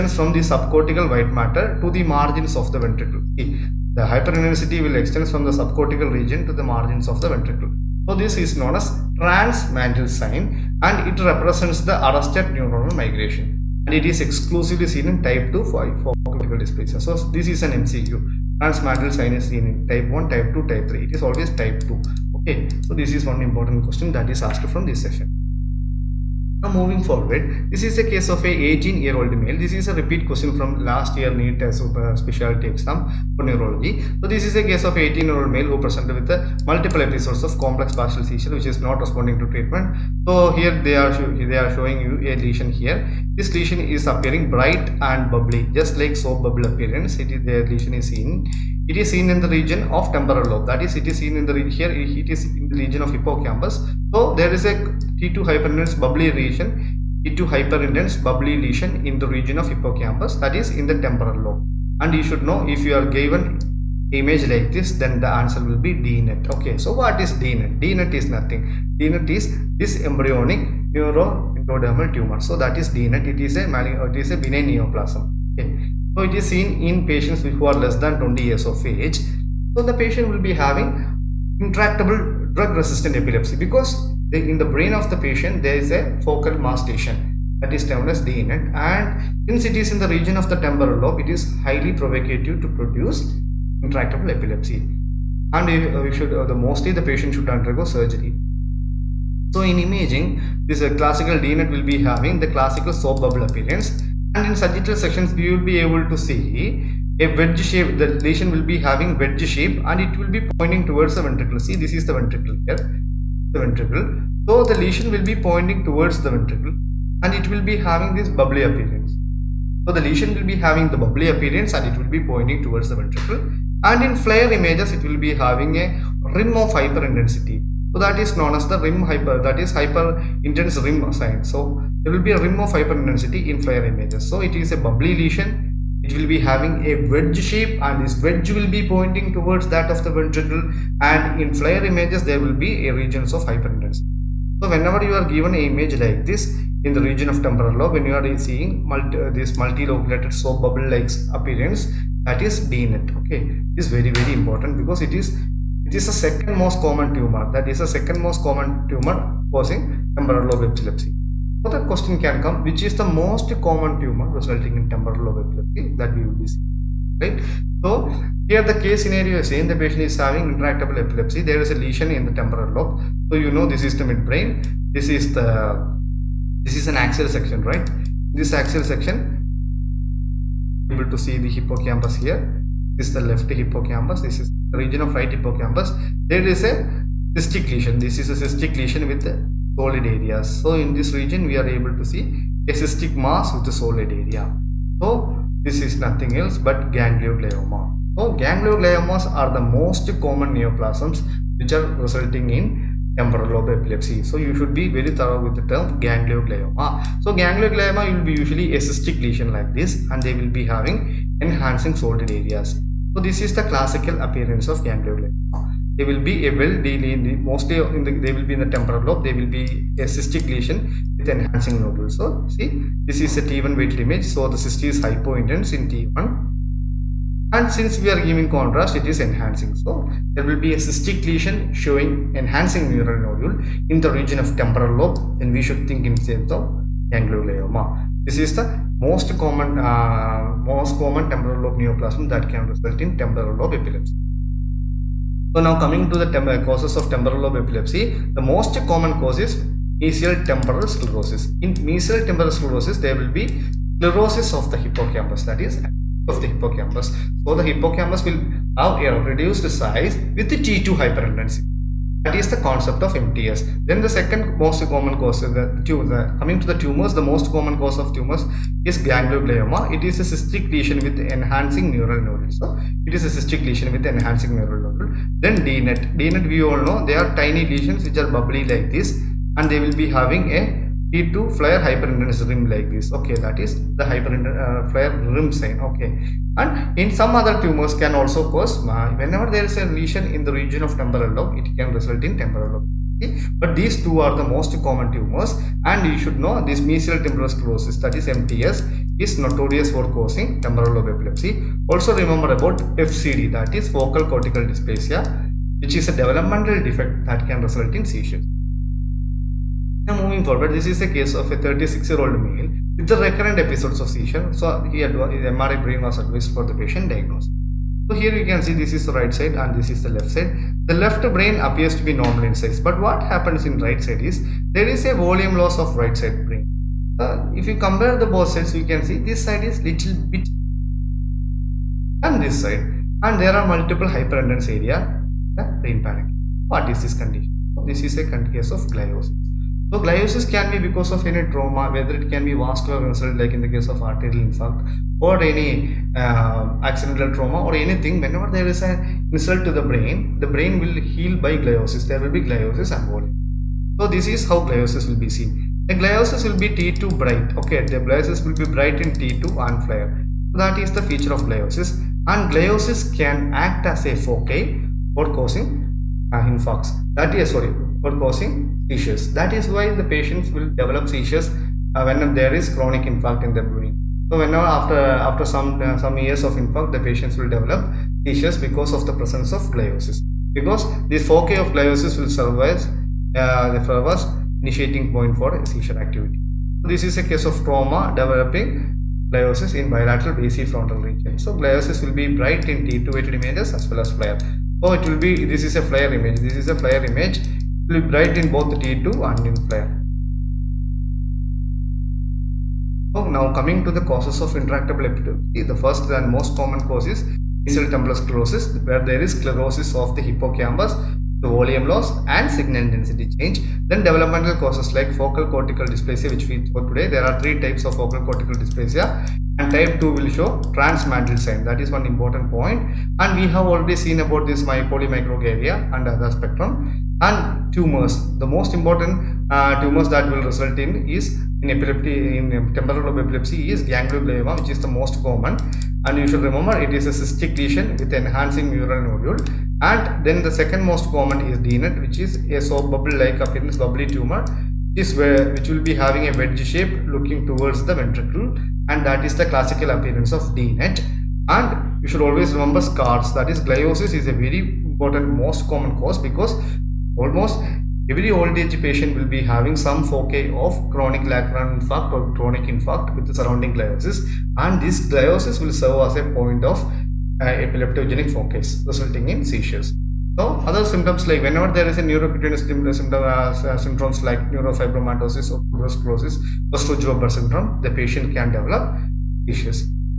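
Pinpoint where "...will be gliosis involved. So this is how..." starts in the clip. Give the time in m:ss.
5:52.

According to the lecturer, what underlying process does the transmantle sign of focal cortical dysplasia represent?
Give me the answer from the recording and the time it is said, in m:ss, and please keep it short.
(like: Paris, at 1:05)
Arrested neuronal migration, at 0:12.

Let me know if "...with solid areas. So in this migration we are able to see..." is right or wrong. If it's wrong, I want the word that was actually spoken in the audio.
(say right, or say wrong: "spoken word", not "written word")
wrong: "region", not "migration".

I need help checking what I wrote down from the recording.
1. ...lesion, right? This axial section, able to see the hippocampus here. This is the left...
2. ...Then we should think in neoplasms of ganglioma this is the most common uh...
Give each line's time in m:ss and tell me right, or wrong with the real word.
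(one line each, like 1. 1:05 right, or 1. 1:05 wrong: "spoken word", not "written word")
1. 2:57 wrong: "section", not "lesion"
2. 3:55 wrong: "terms", not "neoplasms".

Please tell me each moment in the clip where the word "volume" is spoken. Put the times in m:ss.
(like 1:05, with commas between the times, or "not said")
5:25, 6:51.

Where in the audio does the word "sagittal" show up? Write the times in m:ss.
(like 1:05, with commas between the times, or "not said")
1:44.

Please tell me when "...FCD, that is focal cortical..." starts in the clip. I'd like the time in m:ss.
5:02.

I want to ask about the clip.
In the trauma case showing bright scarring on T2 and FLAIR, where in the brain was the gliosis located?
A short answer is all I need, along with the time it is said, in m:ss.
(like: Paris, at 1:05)
Bilateral frontal region, at 6:29.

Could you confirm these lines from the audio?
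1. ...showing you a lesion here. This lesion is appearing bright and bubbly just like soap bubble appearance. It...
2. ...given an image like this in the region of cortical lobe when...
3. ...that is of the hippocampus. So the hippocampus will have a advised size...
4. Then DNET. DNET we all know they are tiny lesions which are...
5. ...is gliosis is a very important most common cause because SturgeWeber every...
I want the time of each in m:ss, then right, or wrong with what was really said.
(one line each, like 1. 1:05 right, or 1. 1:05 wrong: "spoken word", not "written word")
1. 0:41 right
2. 2:25 wrong: "temporal", not "cortical"
3. 4:15 wrong: "reduced", not "advised"
4. 4:35 right
5. 7:33 wrong: "Almost", not "SturgeWeber".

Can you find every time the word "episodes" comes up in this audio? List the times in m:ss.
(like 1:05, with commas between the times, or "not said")
0:37, 5:13.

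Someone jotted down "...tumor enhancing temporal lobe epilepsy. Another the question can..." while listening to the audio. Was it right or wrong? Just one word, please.
wrong.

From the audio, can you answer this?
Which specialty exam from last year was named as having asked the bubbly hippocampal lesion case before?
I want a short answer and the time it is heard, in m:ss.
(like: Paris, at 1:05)
NEET, at 0:31.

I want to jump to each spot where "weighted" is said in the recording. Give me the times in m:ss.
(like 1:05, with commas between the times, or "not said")
3:43, 6:33.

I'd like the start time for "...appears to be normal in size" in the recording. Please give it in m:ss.
5:21.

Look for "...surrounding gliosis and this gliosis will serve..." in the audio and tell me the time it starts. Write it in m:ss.
7:43.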